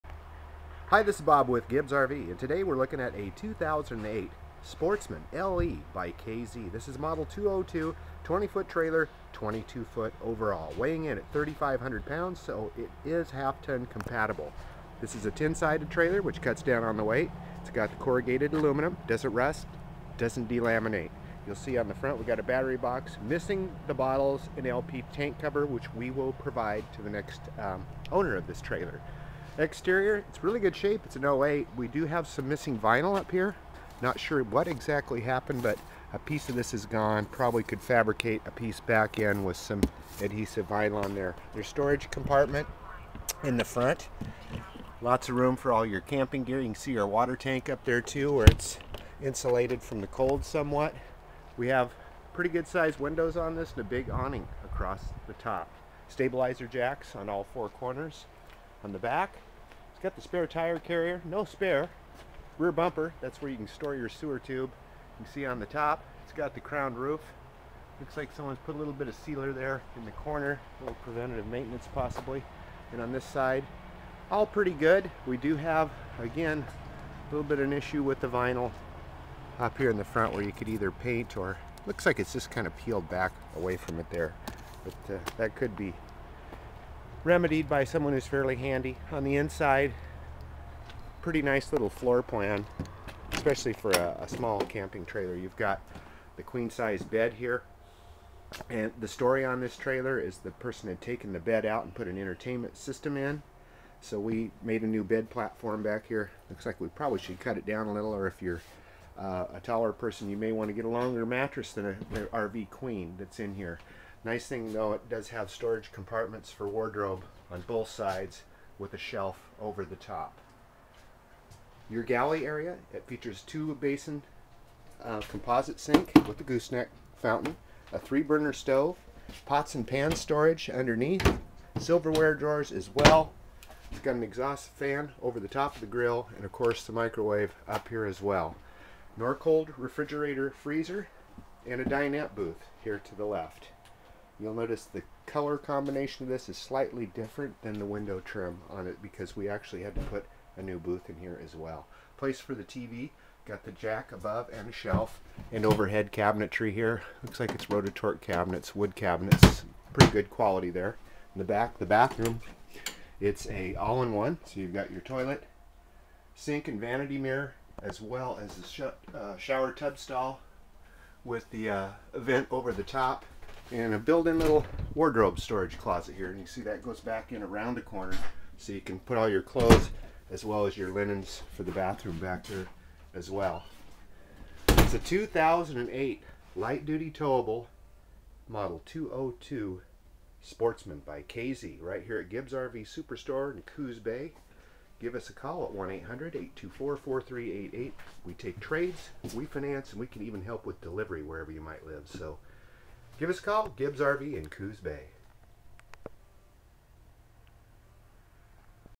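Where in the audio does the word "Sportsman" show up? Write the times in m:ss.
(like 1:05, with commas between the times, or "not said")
0:04, 3:10.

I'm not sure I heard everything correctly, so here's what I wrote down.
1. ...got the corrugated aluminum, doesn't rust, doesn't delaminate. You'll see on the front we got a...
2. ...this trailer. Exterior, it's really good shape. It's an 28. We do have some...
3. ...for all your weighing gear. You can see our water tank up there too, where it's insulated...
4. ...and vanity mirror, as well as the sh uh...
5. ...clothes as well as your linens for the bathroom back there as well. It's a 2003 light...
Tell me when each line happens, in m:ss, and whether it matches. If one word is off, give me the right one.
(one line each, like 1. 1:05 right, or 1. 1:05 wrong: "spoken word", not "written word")
1. 0:17 right
2. 0:28 wrong: "08", not "28"
3. 0:45 wrong: "camping", not "weighing"
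4. 2:46 right
5. 2:59 wrong: "2008", not "2003".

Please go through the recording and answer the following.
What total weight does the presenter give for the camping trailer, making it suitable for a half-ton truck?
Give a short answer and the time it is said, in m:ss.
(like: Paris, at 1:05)
3,500 pounds, at 0:11.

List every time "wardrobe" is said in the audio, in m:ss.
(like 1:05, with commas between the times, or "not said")
1:56, 2:54.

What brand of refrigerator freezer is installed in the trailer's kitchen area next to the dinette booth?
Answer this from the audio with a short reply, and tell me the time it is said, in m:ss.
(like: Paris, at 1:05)
Norcold, at 2:19.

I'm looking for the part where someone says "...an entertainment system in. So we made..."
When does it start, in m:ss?
1:42.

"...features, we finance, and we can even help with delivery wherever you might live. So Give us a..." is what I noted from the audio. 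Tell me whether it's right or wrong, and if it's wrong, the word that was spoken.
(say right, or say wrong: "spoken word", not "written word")
wrong: "trades", not "features".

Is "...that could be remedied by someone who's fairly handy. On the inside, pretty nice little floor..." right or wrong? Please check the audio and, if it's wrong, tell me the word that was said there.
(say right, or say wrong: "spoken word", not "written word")
right.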